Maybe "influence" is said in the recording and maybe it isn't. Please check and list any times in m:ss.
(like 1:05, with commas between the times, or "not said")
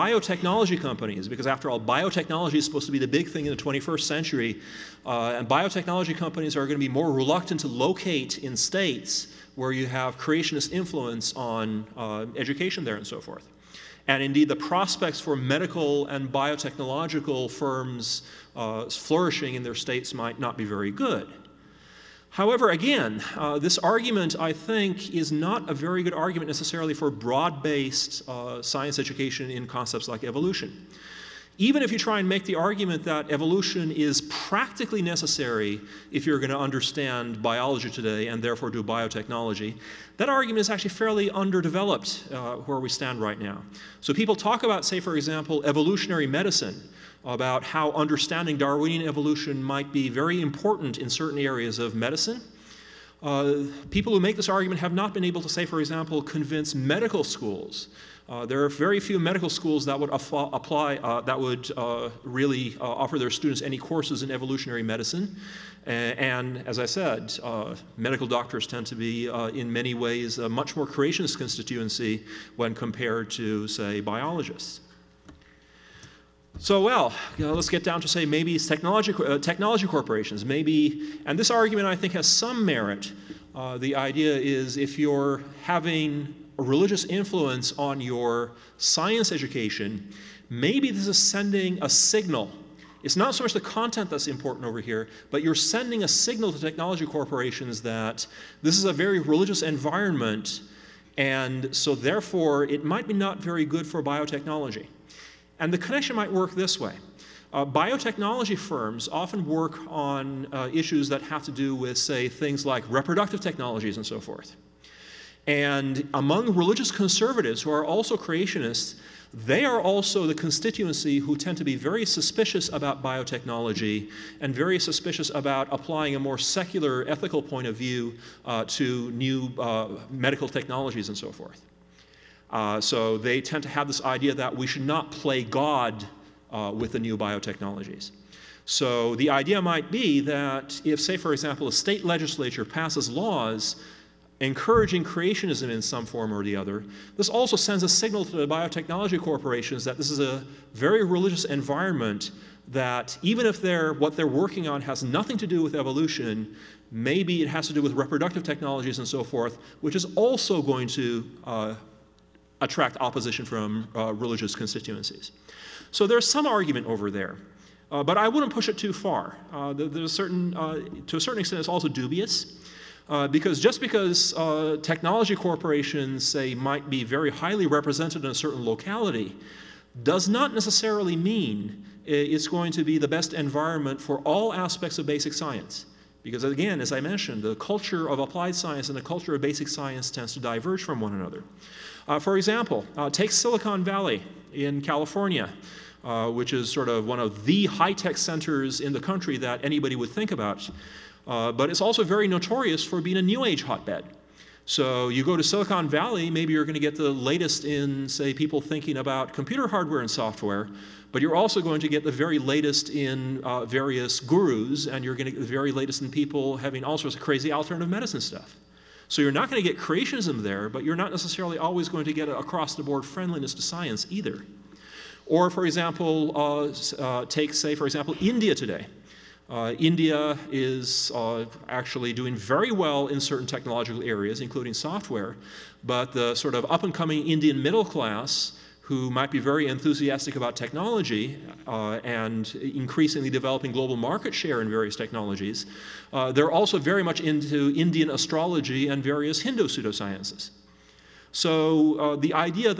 0:10, 1:27.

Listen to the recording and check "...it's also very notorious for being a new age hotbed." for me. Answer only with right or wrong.
right.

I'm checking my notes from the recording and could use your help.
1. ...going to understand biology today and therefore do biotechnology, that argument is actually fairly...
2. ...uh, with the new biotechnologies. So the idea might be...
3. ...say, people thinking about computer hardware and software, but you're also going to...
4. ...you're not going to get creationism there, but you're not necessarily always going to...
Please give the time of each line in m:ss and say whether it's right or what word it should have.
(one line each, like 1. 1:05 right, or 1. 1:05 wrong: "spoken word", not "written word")
1. 0:36 right
2. 2:16 right
3. 3:28 right
4. 3:39 right.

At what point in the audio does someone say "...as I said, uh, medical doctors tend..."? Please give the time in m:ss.
1:06.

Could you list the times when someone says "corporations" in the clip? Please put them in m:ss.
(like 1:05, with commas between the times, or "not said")
1:19, 1:37, 2:29, 2:55.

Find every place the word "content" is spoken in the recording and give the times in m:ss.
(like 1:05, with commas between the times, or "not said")
1:33.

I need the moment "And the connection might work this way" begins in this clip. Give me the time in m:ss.
1:45.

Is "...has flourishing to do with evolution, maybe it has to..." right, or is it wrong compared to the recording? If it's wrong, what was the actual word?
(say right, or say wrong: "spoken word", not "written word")
wrong: "nothing", not "flourishing".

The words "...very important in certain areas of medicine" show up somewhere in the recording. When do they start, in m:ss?
0:50.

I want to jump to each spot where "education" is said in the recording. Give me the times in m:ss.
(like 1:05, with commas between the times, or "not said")
0:12, 0:28, 1:29.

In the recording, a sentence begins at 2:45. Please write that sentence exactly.
So there's some argument over there.